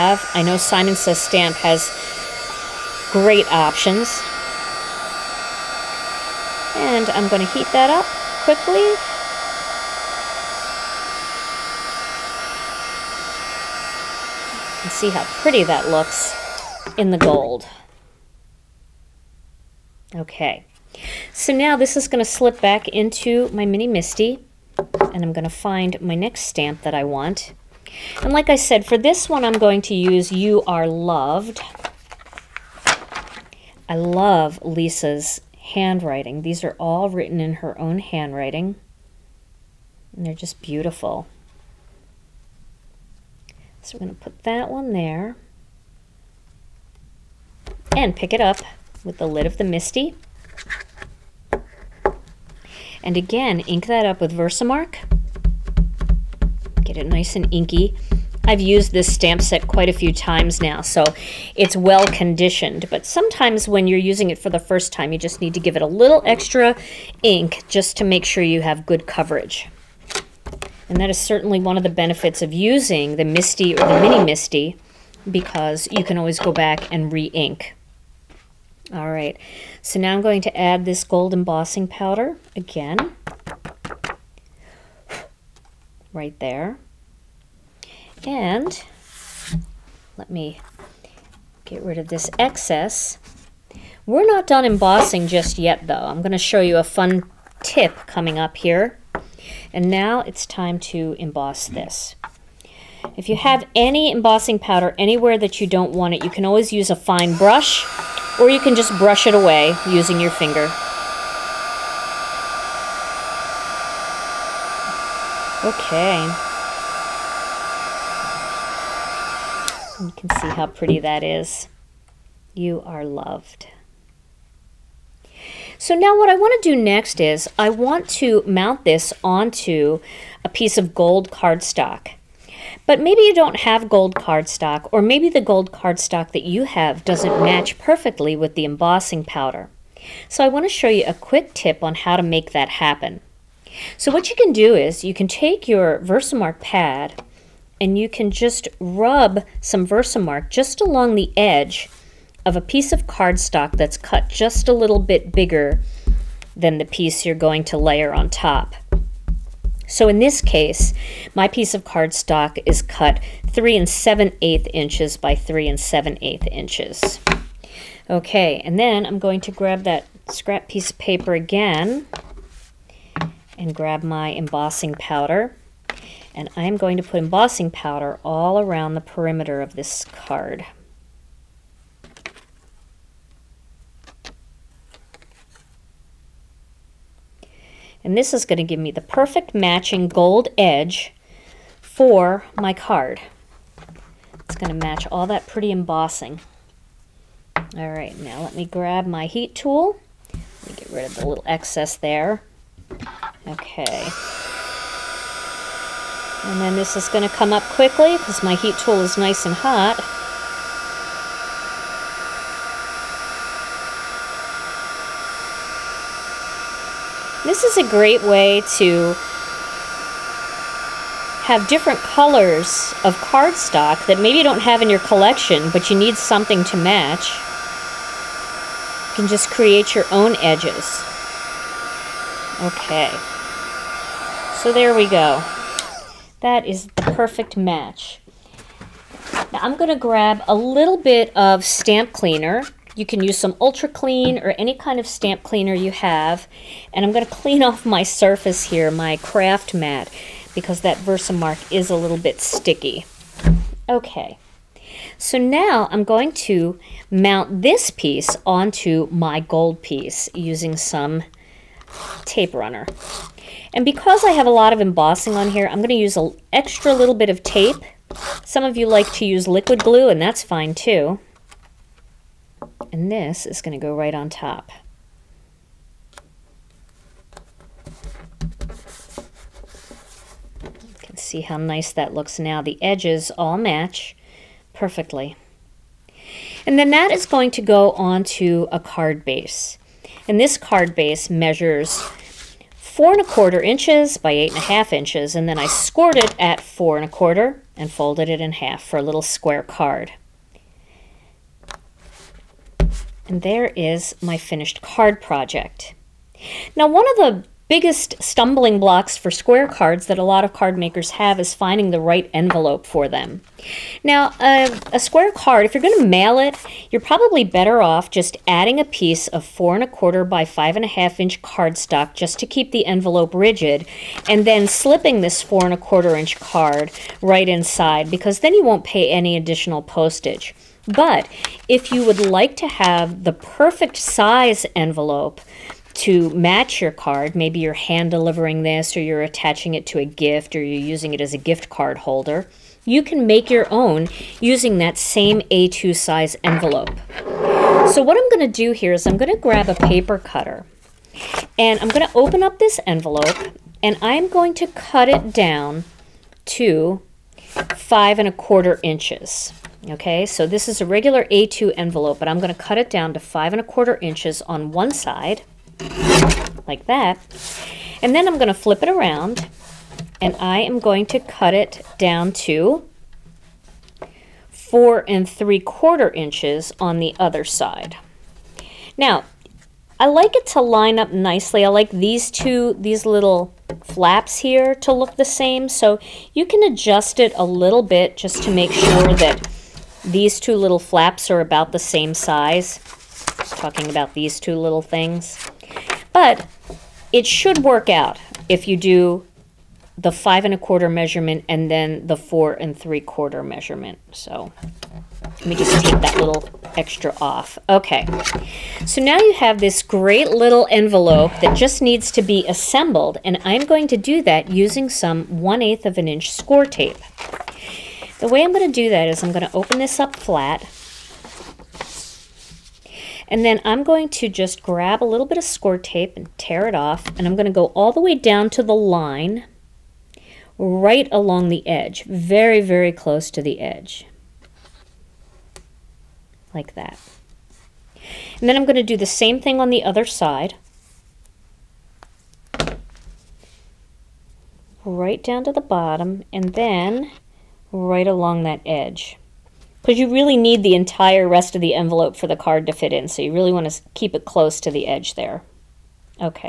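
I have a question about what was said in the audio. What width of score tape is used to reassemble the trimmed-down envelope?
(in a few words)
1/8 inch.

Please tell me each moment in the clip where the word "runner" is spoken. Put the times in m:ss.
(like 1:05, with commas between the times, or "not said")
4:22.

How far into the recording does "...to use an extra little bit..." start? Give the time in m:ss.
4:25.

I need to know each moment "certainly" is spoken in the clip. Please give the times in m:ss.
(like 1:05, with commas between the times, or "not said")
1:11.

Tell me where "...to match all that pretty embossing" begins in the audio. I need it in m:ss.
3:14.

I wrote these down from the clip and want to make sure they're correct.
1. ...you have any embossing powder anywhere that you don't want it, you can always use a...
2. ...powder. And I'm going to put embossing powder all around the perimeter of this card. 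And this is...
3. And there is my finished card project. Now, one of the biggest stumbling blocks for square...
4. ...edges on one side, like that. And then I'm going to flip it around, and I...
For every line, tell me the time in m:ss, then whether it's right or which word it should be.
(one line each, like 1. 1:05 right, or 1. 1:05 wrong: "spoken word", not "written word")
1. 1:43 right
2. 2:54 right
3. 5:03 right
4. 6:04 wrong: "inches", not "edges".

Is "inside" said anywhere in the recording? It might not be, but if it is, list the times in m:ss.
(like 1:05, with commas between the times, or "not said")
5:27.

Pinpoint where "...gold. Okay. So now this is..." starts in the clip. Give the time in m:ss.
0:17.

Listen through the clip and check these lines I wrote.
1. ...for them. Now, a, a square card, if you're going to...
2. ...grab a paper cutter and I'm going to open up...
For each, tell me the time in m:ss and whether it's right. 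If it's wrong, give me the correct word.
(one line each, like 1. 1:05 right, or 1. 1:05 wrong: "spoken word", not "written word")
1. 5:12 right
2. 5:49 right.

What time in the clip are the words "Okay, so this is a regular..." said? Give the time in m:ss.
5:59.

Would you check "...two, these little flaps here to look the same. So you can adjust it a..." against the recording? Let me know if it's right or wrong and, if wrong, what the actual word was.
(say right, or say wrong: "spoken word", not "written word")
right.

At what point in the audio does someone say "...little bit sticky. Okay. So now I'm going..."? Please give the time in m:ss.
4:11.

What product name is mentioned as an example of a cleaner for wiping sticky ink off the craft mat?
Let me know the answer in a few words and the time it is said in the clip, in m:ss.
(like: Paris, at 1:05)
Ultra Clean, at 4:03.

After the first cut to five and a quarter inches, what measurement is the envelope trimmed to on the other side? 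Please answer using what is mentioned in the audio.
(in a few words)
4 3/4 inches.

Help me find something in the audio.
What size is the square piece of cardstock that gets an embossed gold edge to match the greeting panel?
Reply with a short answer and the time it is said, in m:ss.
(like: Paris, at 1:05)
3 7/8 by 3 7/8 inches, at 2:43.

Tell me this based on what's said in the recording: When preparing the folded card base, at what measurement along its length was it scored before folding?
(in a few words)
4 1/4 inches.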